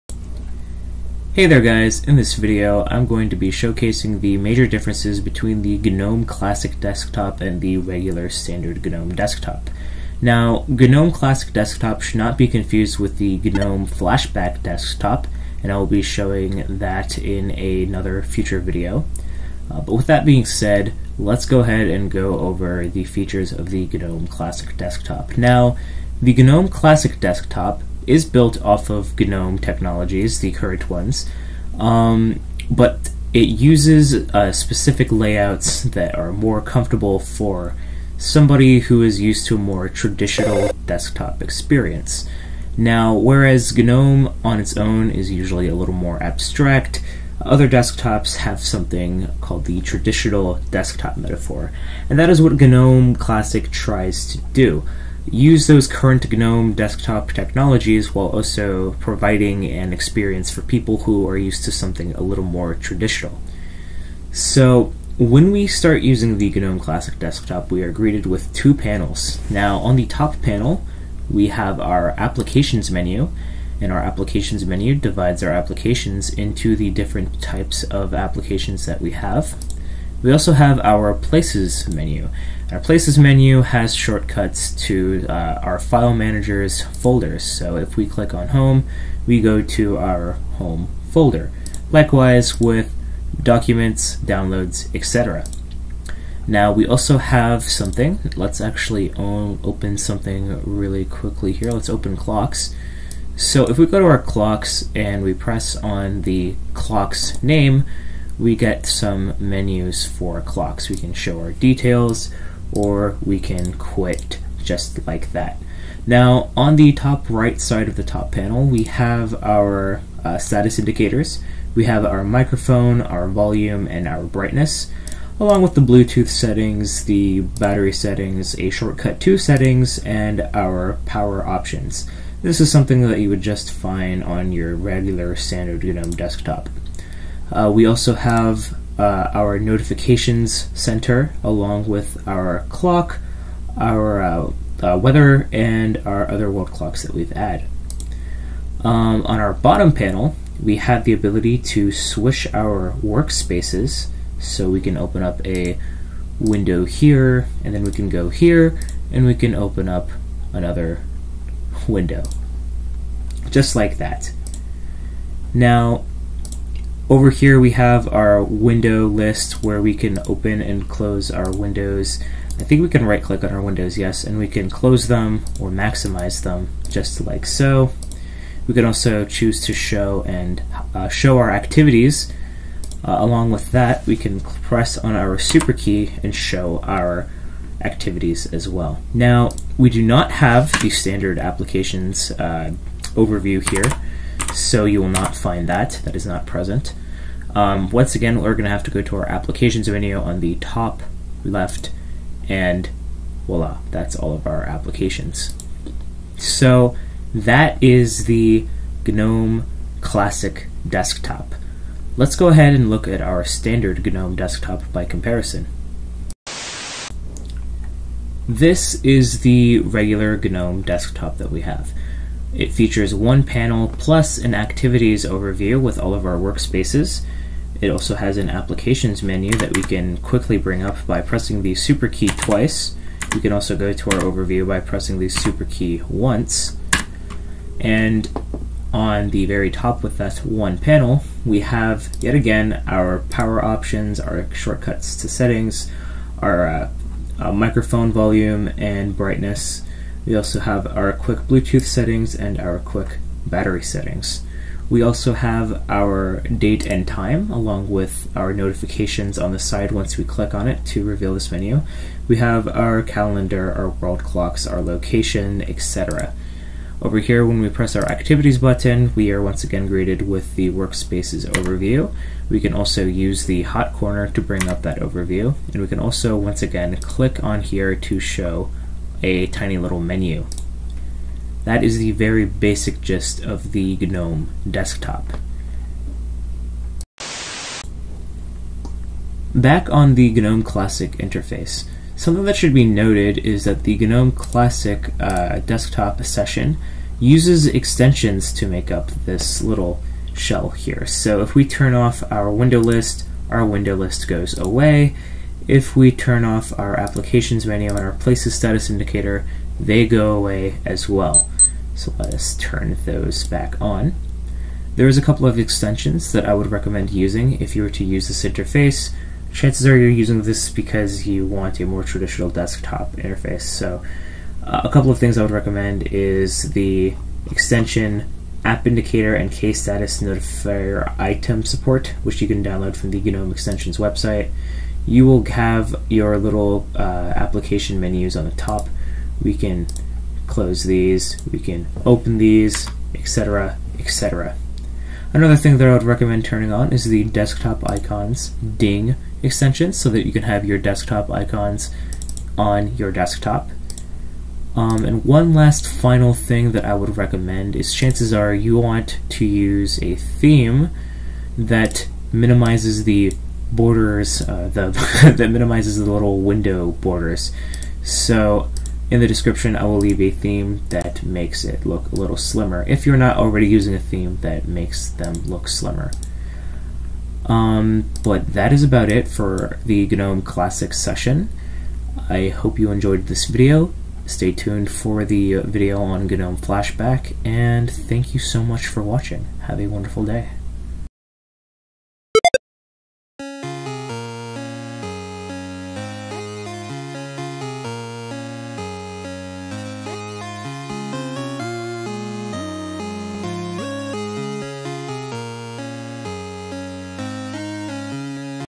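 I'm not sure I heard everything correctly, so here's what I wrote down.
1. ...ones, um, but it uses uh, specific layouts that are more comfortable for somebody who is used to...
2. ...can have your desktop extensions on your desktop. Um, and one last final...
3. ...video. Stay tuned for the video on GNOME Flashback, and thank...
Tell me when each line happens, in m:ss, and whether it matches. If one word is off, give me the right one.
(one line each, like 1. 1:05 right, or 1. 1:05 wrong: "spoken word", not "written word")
1. 0:30 right
2. 5:50 wrong: "icons", not "extensions"
3. 6:23 right.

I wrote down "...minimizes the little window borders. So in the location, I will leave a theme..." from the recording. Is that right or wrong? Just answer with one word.
wrong.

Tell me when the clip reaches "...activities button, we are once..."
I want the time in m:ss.
4:28.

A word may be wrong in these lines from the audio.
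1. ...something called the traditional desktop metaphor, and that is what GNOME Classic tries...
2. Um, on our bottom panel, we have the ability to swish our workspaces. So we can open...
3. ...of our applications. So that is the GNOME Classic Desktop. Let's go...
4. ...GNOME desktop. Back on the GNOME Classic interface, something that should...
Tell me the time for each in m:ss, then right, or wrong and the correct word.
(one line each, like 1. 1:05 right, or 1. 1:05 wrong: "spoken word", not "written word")
1. 0:48 right
2. 2:28 right
3. 3:24 right
4. 4:43 right.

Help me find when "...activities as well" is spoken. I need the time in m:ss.
3:07.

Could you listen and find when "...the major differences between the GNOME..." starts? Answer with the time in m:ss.
0:04.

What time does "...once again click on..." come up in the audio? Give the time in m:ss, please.
4:36.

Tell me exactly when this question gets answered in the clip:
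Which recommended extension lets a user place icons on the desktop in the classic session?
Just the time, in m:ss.
5:47.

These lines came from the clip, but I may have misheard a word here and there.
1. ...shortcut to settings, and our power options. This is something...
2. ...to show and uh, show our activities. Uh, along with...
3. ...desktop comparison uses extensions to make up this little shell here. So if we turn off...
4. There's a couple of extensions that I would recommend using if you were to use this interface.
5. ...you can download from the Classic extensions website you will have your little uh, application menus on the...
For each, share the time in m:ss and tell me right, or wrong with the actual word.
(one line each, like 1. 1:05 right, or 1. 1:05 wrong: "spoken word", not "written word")
1. 2:08 right
2. 2:59 right
3. 4:55 wrong: "session", not "comparison"
4. 5:14 right
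5. 5:32 wrong: "GNOME", not "Classic".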